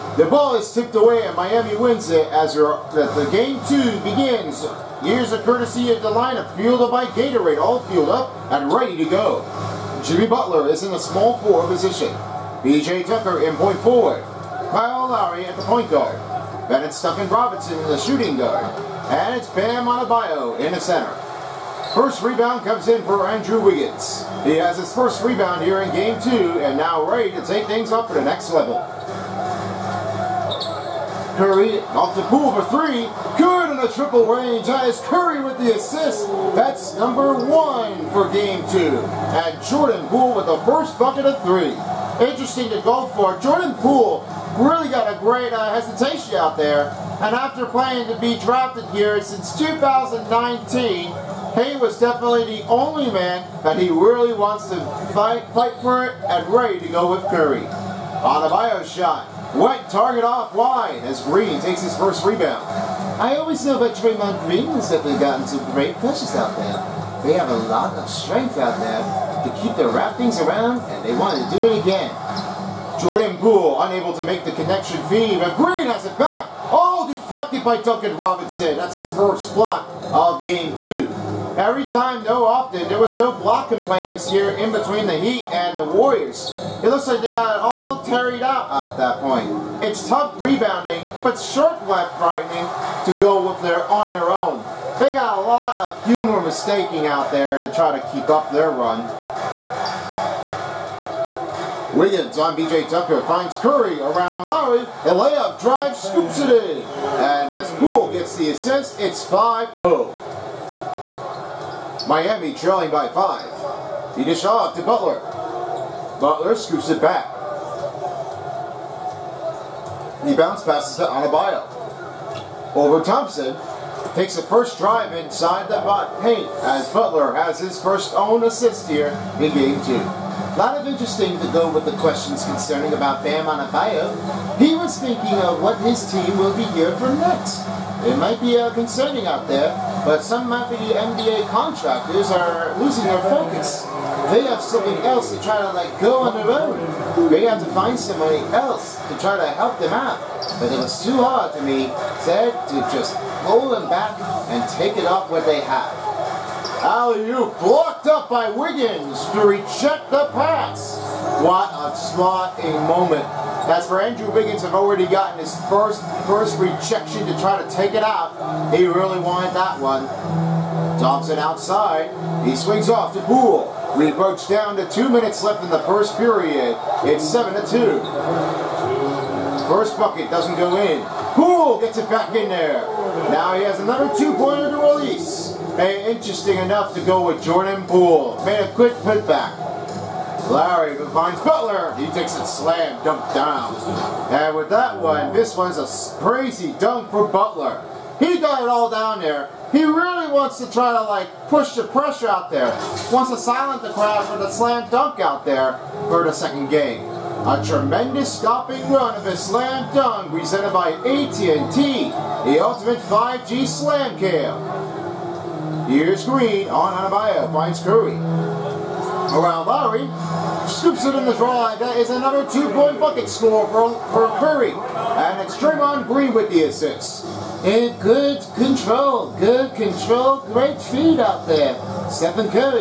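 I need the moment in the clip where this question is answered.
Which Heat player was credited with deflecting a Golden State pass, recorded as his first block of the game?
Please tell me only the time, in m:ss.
1:17.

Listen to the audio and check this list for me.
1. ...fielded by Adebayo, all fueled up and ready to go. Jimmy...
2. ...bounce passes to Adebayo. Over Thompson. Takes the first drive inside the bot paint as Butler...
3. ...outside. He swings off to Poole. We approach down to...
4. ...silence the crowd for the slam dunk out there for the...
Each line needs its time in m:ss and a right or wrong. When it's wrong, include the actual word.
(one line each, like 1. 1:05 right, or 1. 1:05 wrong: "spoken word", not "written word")
1. 0:06 wrong: "Gatorade", not "Adebayo"
2. 2:00 right
3. 2:51 right
4. 3:23 right.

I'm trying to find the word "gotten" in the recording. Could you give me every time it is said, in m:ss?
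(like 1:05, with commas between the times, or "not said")
1:05, 2:45.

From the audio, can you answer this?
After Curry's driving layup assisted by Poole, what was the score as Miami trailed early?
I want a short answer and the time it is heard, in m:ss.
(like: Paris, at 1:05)
5-0, at 1:49.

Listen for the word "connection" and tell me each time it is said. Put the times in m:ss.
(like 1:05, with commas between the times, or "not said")
1:14.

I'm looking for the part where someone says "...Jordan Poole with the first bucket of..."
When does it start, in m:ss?
0:39.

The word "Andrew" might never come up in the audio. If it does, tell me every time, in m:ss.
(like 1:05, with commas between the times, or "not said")
0:23, 2:43.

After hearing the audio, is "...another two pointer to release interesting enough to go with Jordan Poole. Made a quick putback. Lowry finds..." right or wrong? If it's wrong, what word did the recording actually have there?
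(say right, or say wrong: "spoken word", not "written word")
right.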